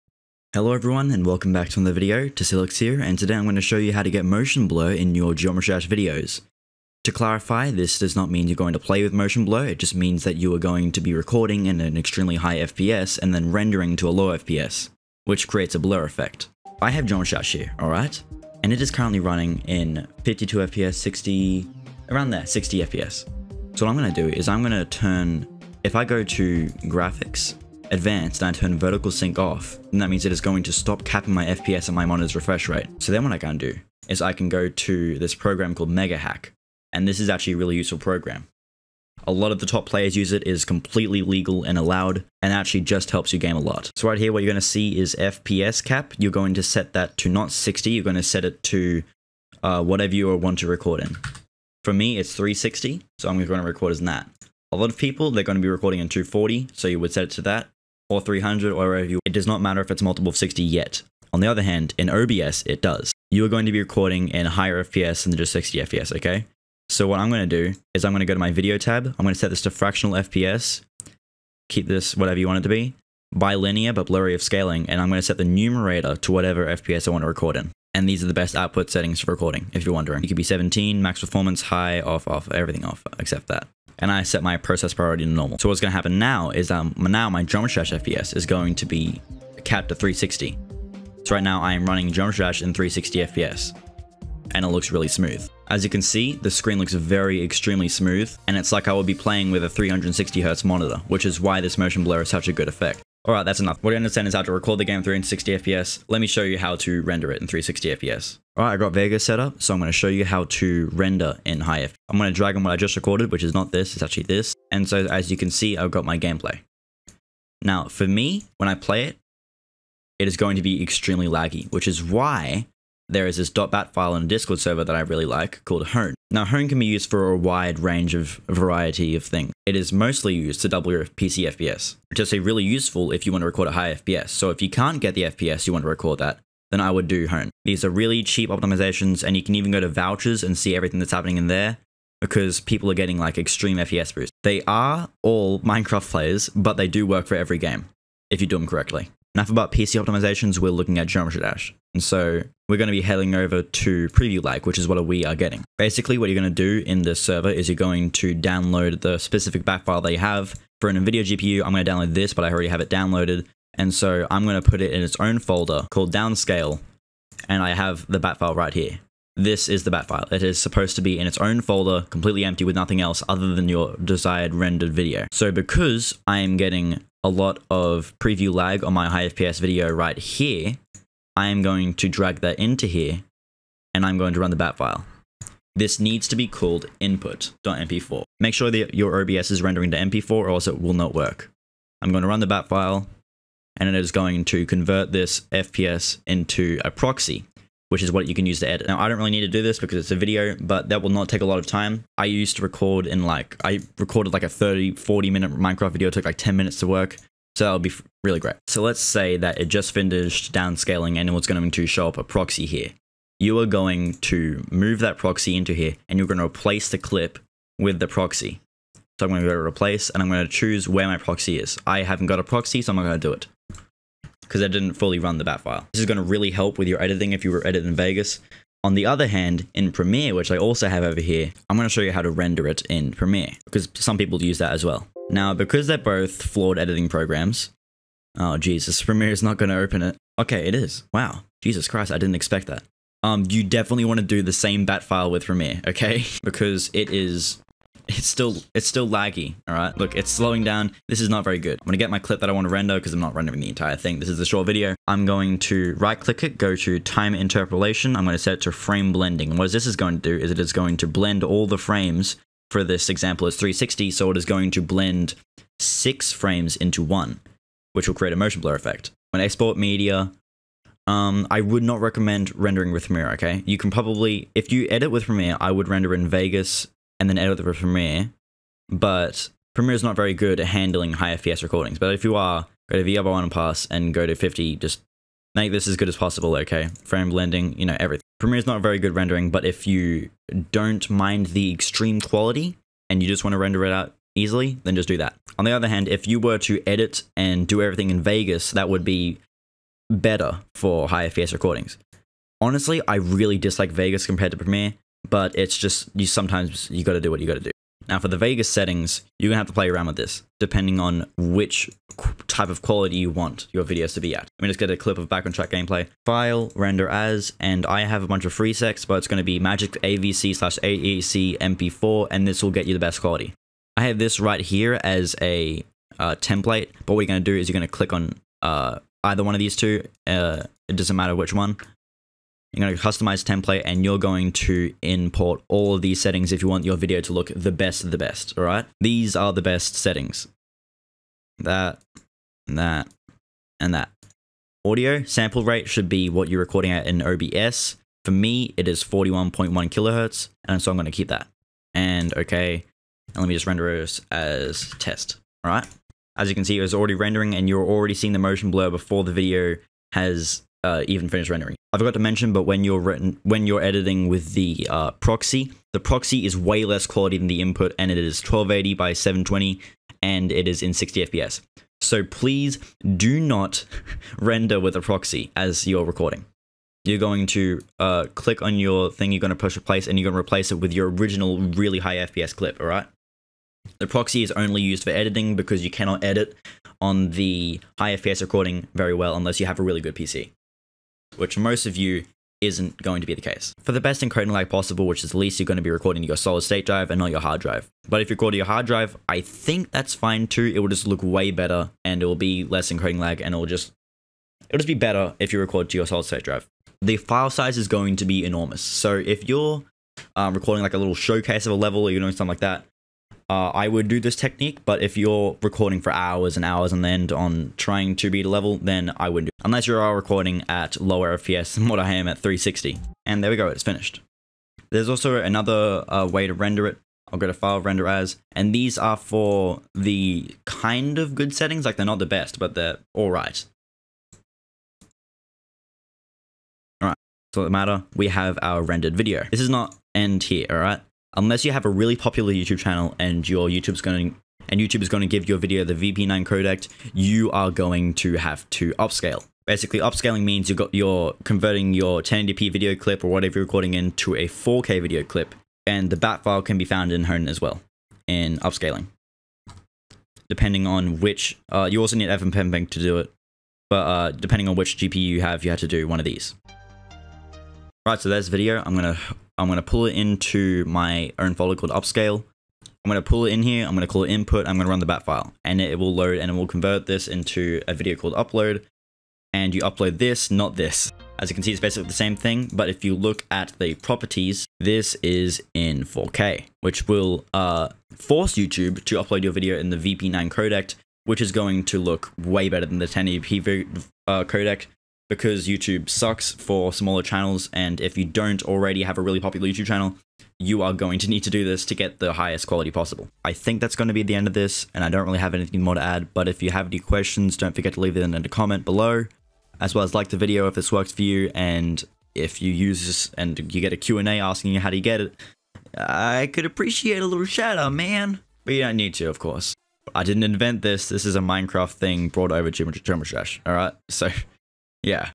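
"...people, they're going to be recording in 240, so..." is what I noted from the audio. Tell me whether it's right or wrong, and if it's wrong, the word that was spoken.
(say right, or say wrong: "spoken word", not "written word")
right.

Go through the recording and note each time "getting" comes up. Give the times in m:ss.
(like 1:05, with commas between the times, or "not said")
2:22, 2:35, 2:56.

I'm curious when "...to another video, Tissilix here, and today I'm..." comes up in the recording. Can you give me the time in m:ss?
0:01.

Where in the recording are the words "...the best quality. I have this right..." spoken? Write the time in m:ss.
5:22.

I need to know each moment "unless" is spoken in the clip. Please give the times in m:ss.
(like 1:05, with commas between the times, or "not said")
6:29, 6:59, 7:21.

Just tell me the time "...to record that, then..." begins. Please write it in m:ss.
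2:15.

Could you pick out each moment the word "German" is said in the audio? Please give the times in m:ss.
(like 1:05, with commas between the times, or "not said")
not said.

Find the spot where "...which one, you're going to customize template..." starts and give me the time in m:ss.
5:31.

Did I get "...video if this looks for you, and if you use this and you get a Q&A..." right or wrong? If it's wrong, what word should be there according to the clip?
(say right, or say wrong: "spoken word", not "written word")
wrong: "works", not "looks".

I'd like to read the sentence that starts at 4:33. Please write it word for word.
You can probably, if you edit with Premiere, I would render in Vegas and then edit with Premiere.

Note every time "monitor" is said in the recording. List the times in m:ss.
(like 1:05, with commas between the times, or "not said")
0:32, 1:40.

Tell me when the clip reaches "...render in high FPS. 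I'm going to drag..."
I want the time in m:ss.
1:50.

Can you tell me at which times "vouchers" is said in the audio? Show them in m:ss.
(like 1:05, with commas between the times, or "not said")
2:19.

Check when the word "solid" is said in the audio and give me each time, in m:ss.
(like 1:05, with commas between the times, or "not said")
6:36, 6:46.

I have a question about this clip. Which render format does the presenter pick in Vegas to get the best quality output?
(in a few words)
MAGIX AVC/AAC MP4.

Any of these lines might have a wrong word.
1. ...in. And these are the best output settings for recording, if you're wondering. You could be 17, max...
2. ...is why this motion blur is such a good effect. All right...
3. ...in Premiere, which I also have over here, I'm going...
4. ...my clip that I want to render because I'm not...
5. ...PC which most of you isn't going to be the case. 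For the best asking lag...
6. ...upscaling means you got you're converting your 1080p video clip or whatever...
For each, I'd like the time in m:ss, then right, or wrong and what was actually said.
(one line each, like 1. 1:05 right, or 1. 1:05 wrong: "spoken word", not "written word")
1. 1:17 right
2. 1:41 right
3. 3:49 right
4. 4:12 right
5. 6:30 wrong: "encoding", not "asking"
6. 7:29 right.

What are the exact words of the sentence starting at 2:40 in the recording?
For an NVIDIA GPU, I'm going to download this, but I already have it downloaded.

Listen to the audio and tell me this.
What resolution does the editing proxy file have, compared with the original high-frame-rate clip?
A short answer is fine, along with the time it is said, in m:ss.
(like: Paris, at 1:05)
1280 by 720, at 6:08.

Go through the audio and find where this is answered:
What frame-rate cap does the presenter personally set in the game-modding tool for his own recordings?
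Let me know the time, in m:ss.
0:51.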